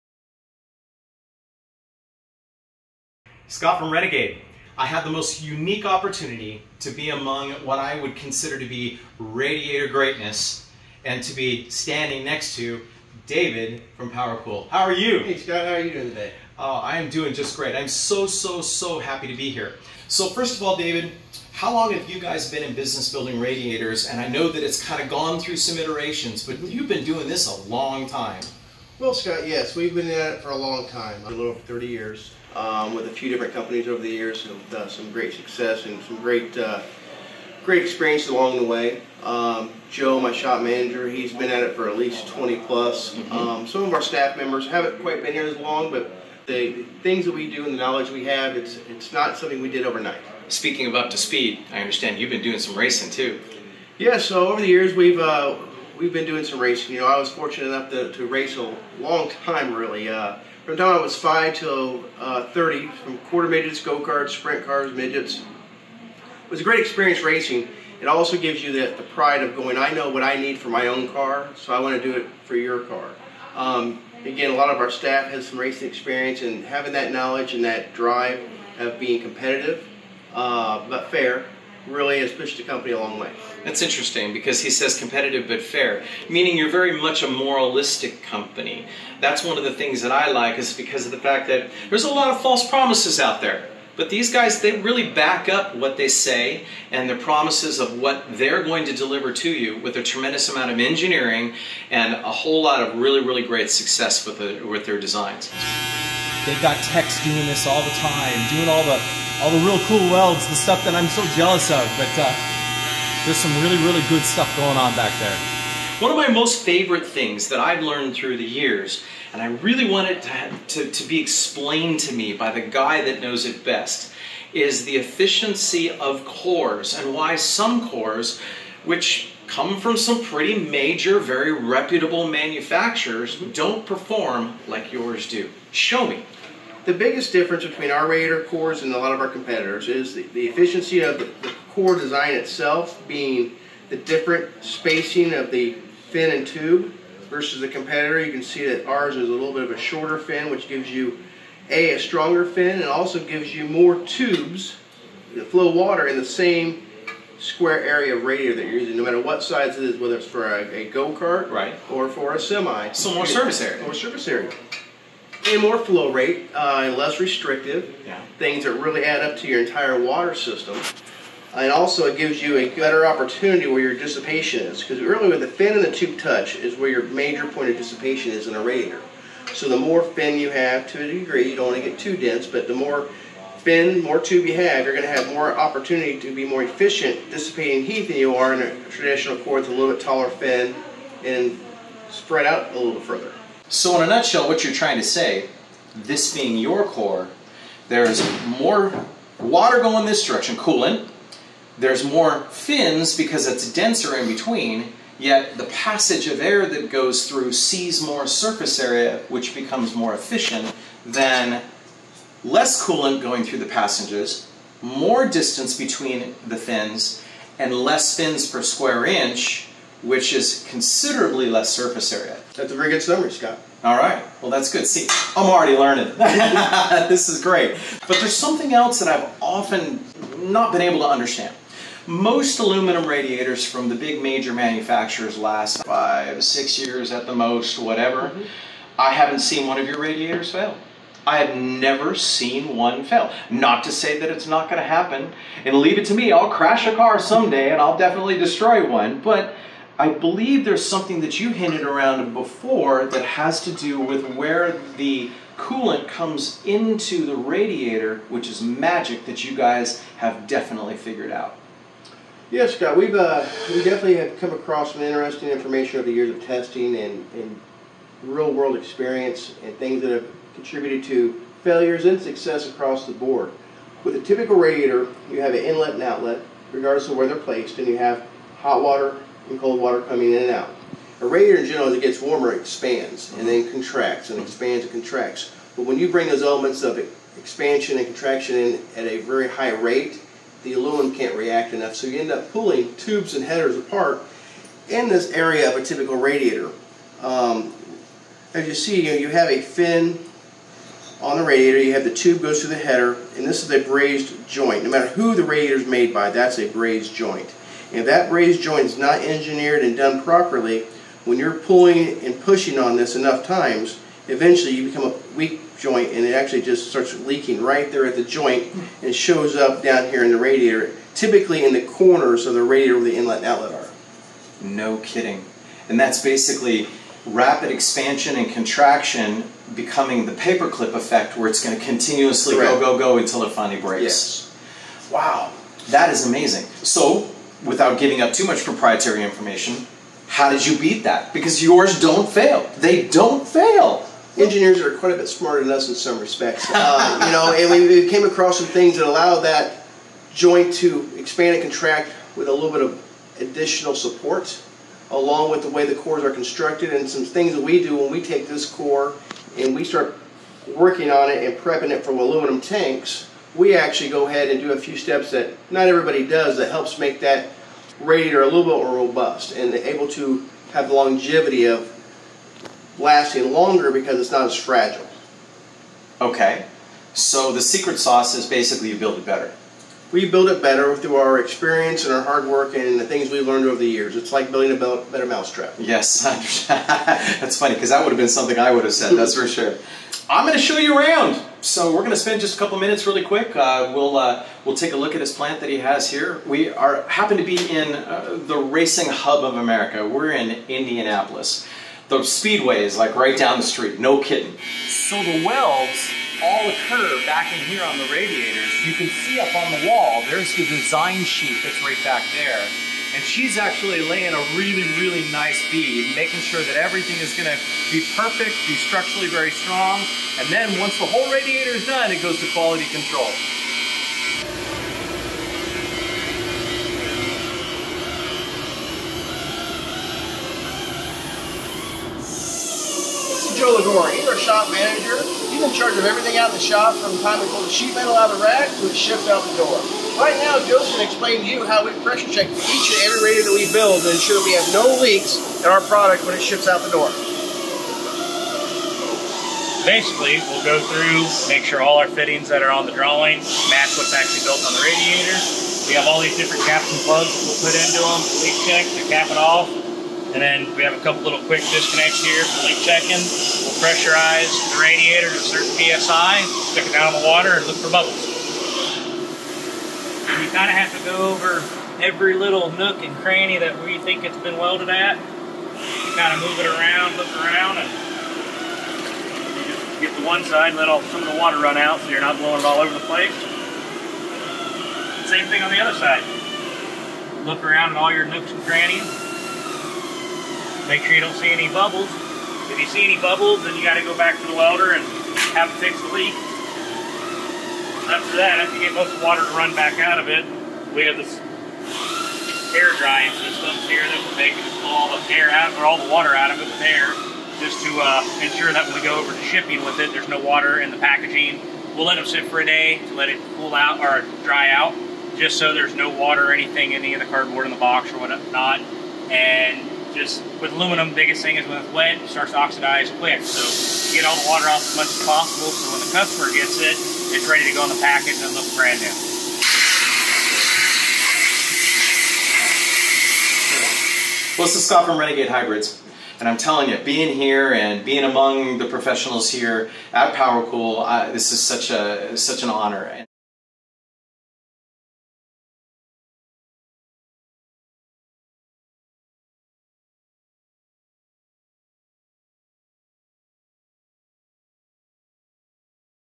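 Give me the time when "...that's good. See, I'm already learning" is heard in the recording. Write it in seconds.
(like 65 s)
224 s.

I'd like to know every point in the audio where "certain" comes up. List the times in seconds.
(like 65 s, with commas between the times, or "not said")
465 s.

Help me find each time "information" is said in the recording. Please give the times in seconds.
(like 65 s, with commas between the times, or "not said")
265 s, 339 s.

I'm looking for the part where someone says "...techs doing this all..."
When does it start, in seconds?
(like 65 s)
106 s.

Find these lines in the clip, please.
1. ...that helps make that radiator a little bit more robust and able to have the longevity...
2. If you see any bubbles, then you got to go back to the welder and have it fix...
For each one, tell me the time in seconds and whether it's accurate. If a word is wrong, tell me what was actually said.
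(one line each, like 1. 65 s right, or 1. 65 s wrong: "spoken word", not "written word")
1. 366 s right
2. 492 s right.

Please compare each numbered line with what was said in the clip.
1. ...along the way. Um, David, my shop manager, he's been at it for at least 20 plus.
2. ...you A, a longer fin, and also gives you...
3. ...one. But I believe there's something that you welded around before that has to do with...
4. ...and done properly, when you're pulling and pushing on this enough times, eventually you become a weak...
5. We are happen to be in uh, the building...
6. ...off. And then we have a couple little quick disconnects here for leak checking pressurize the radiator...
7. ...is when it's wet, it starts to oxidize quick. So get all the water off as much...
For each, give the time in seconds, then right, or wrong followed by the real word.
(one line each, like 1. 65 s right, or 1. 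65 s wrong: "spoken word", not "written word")
1. 38 s wrong: "Joe", not "David"
2. 150 s wrong: "stronger", not "longer"
3. 248 s wrong: "hinted", not "welded"
4. 309 s right
5. 396 s wrong: "racing", not "building"
6. 459 s right
7. 521 s right.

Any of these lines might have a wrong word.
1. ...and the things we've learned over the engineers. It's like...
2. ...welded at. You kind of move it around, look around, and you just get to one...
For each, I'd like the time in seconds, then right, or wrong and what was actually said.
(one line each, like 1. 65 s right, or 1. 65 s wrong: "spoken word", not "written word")
1. 382 s wrong: "years", not "engineers"
2. 474 s right.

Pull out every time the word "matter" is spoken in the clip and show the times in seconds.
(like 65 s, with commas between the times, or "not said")
159 s, 304 s.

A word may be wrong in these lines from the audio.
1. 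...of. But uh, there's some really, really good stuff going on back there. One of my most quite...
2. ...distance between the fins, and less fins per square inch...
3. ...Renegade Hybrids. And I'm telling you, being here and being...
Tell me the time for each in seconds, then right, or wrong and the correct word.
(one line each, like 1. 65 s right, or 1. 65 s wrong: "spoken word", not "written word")
1. 111 s wrong: "favorite", not "quite"
2. 215 s right
3. 535 s right.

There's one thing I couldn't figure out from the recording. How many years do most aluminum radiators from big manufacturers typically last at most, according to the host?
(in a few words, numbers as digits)
5 or 6 years.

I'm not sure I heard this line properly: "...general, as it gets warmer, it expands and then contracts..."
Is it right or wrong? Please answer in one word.
right.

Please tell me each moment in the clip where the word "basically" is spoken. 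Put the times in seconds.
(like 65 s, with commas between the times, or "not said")
326 s, 378 s, 449 s.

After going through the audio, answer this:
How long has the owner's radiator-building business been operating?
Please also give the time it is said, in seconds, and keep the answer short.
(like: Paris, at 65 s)
Over 30 years, at 31 s.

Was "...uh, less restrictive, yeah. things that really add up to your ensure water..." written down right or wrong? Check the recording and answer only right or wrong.
wrong.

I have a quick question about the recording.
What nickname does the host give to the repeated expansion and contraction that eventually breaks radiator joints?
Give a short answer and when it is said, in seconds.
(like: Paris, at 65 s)
The paperclip effect, at 330 s.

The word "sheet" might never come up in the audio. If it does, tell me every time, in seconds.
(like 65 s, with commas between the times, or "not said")
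411 s, 437 s.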